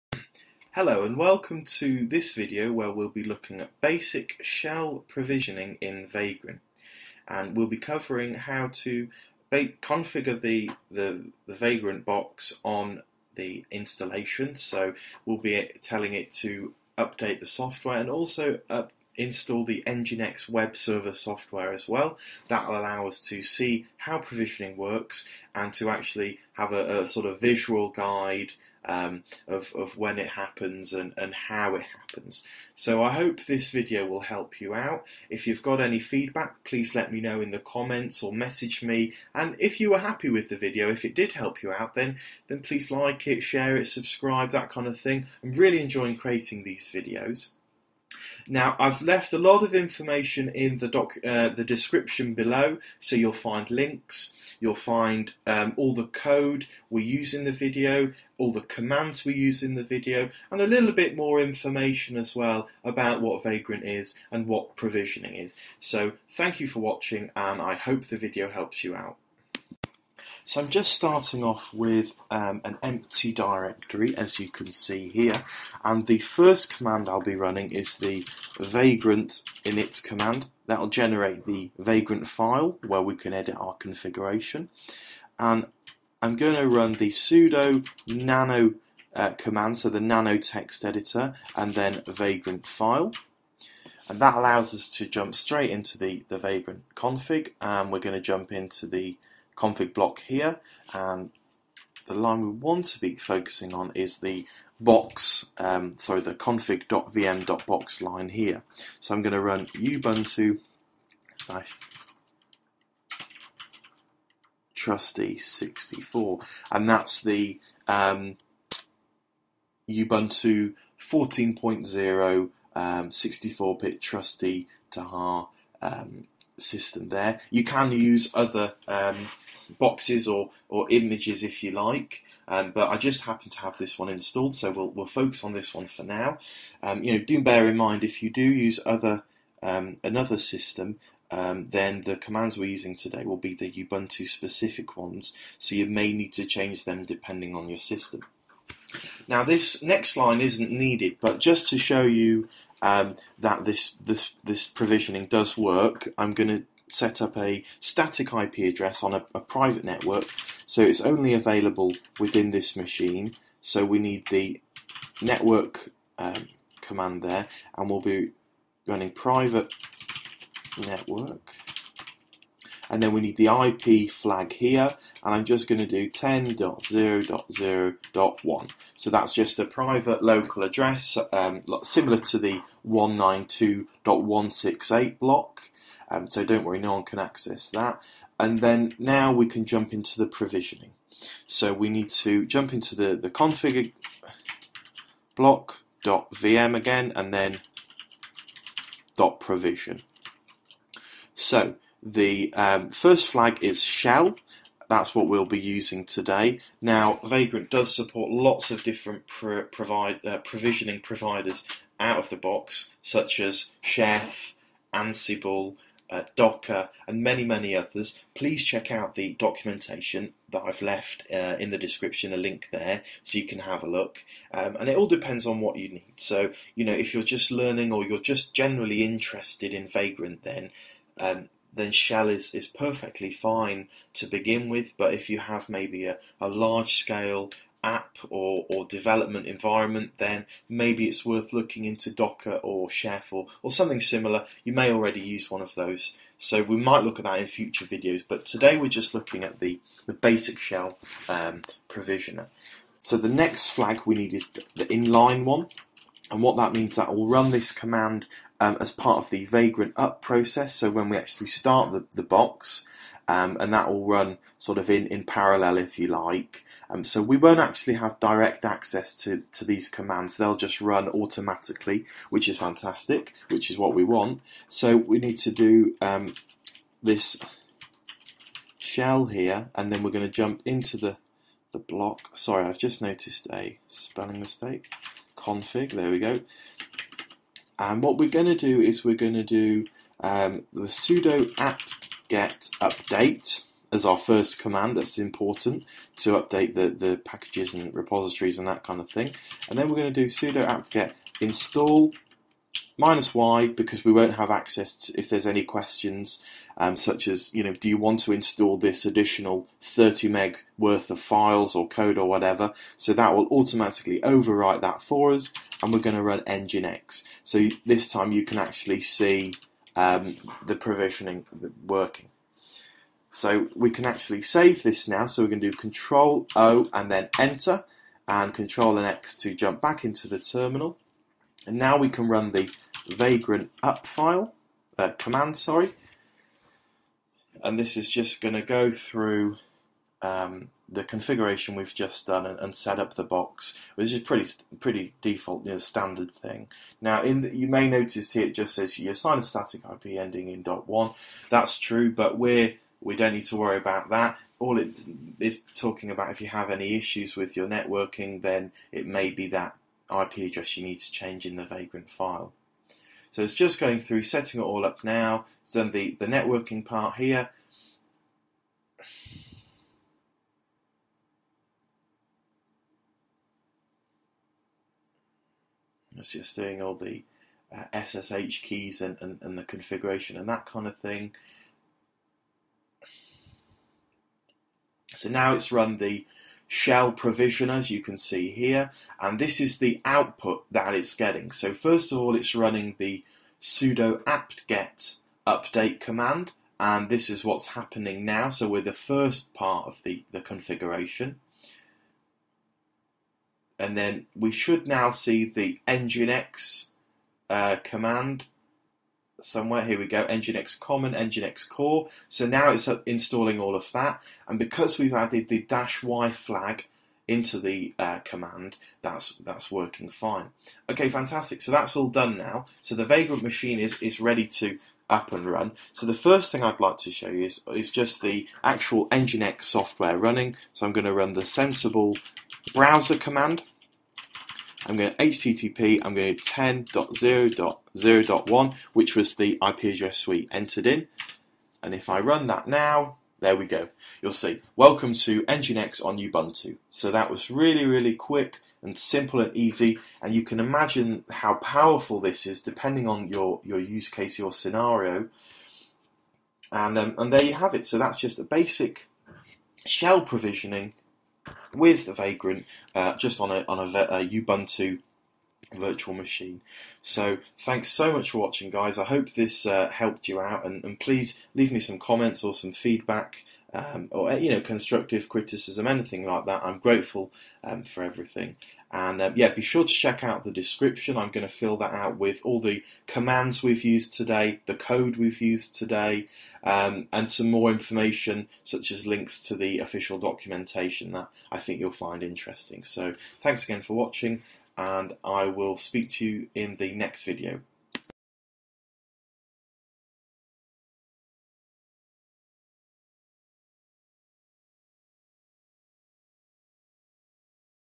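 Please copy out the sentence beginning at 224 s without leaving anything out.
Um, and it all depends on what you need.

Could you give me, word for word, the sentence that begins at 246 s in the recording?
So we might look at that in future videos, but today we're just looking at the, the basic shell um, provisioner.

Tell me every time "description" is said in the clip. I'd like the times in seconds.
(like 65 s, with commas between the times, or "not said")
51 s, 221 s, 480 s.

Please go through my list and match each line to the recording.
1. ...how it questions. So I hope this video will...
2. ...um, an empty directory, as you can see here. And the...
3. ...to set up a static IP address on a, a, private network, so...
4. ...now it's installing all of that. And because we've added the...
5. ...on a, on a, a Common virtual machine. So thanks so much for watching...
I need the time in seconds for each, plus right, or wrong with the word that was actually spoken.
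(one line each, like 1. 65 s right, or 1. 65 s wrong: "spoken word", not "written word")
1. 31 s wrong: "happens", not "questions"
2. 72 s right
3. 156 s right
4. 412 s right
5. 463 s wrong: "Ubuntu", not "Common".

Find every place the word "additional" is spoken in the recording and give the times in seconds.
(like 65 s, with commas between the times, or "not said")
309 s.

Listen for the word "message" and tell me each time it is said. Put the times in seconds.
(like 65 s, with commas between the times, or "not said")
38 s.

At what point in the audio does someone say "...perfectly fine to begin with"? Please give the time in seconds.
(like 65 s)
232 s.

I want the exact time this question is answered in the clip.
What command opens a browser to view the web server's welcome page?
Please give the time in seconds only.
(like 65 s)
431 s.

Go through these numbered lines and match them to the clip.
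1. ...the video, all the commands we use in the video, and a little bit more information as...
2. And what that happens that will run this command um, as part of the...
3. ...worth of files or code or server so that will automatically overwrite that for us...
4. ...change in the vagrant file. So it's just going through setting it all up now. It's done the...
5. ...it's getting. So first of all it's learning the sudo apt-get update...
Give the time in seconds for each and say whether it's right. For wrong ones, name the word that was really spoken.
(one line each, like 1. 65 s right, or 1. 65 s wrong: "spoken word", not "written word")
1. 57 s right
2. 256 s wrong: "means", not "happens"
3. 310 s wrong: "whatever", not "server"
4. 361 s right
5. 390 s wrong: "running", not "learning".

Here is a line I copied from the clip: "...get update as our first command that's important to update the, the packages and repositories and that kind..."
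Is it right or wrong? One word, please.
right.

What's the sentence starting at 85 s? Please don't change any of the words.
And I'm going to run the sudo nano uh, command, so the nano text editor, and then vagrant file.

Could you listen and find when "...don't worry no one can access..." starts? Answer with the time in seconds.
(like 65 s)
186 s.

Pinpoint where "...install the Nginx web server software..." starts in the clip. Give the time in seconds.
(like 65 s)
19 s.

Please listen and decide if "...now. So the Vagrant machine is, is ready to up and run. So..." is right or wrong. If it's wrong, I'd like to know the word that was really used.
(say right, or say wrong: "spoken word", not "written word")
right.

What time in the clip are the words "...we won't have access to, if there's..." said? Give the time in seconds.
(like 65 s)
304 s.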